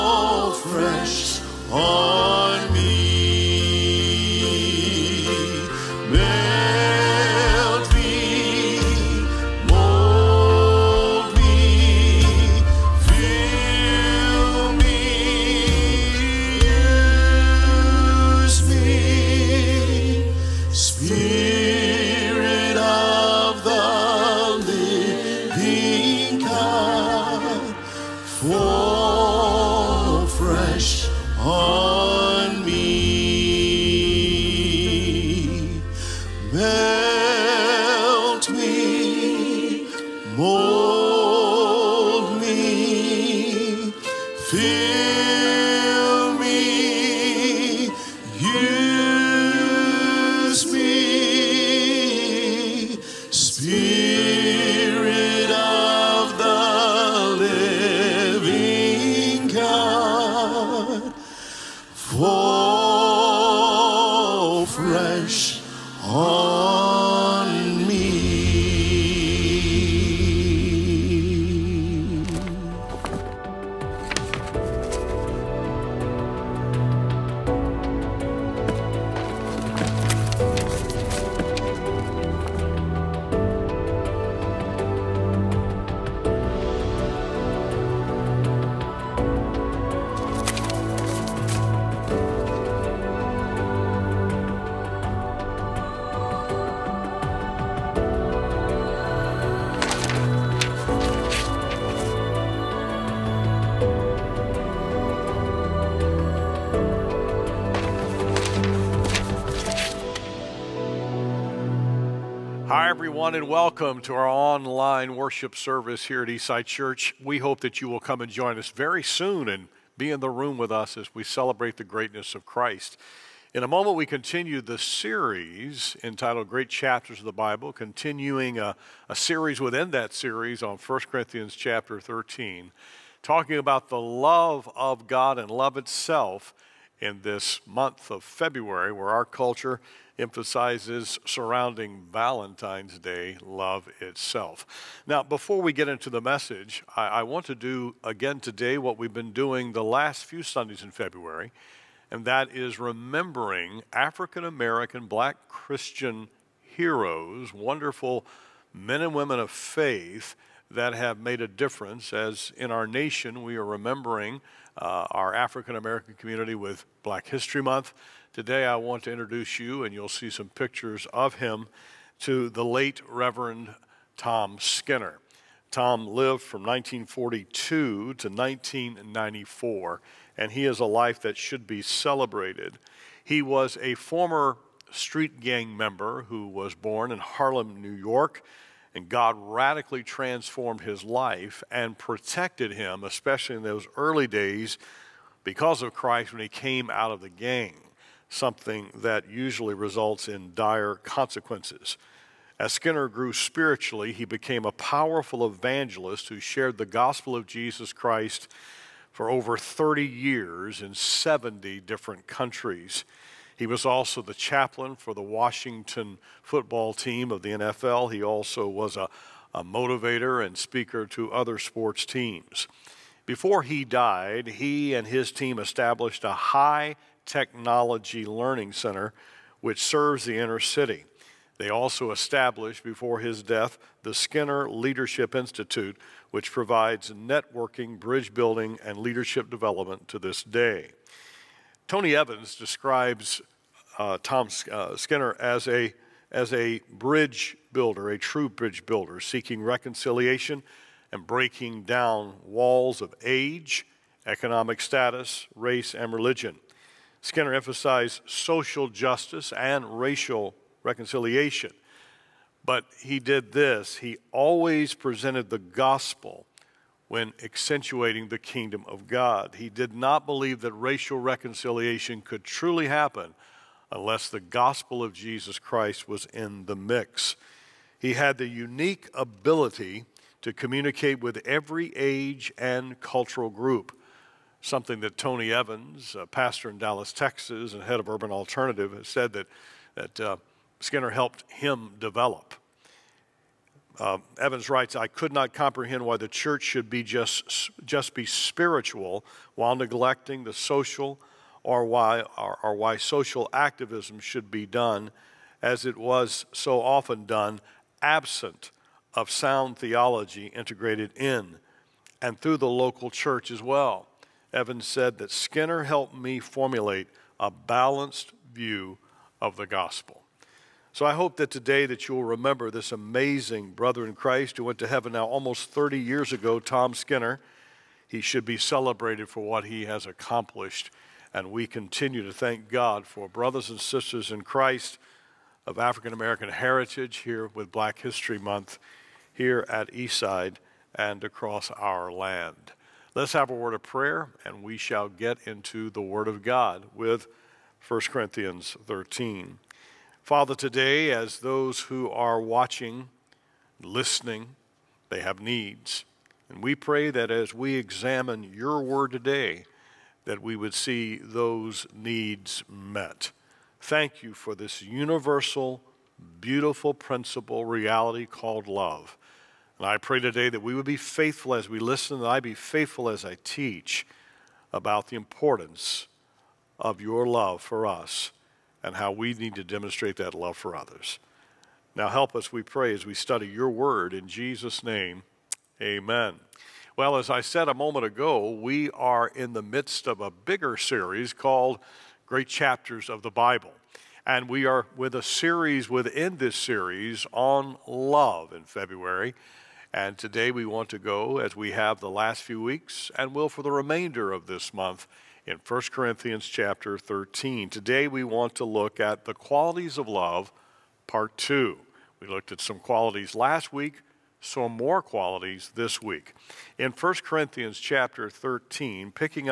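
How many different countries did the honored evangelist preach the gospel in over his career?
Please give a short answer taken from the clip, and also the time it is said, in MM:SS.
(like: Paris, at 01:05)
70, at 03:30.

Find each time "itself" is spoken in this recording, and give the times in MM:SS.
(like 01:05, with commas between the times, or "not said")
02:15, 02:23.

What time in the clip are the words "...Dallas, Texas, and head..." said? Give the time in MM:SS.
04:46.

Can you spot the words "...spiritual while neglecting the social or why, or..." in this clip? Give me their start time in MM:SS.
04:58.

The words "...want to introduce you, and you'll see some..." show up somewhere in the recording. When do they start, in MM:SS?
02:48.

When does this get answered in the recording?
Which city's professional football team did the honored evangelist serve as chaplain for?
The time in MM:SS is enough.
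03:35.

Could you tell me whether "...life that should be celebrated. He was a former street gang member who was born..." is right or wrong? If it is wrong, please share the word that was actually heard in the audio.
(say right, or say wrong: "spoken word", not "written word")
right.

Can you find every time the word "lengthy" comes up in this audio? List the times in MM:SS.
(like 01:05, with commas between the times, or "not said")
not said.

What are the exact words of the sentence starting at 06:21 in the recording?
Now help us, we pray, as we study your word in Jesus' name.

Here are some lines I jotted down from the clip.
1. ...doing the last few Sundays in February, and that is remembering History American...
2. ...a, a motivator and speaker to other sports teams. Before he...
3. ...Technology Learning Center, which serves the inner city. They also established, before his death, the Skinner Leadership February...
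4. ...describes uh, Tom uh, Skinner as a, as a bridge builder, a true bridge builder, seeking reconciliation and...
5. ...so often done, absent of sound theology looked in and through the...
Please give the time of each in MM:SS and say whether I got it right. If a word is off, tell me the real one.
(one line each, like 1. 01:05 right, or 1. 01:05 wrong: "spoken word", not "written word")
1. 02:29 wrong: "African", not "History"
2. 03:38 right
3. 03:47 wrong: "Institute", not "February"
4. 04:02 right
5. 05:06 wrong: "integrated", not "looked".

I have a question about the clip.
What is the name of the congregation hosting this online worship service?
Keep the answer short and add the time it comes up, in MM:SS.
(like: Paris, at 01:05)
Eastside Church, at 01:56.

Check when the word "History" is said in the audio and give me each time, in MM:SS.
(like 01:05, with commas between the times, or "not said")
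02:47, 05:37.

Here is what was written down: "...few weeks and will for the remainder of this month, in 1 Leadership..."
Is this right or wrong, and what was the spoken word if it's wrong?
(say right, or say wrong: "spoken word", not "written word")
wrong: "Corinthians", not "Leadership".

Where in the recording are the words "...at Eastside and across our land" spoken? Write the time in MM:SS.
05:39.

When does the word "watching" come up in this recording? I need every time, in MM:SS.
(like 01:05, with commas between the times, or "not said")
05:52.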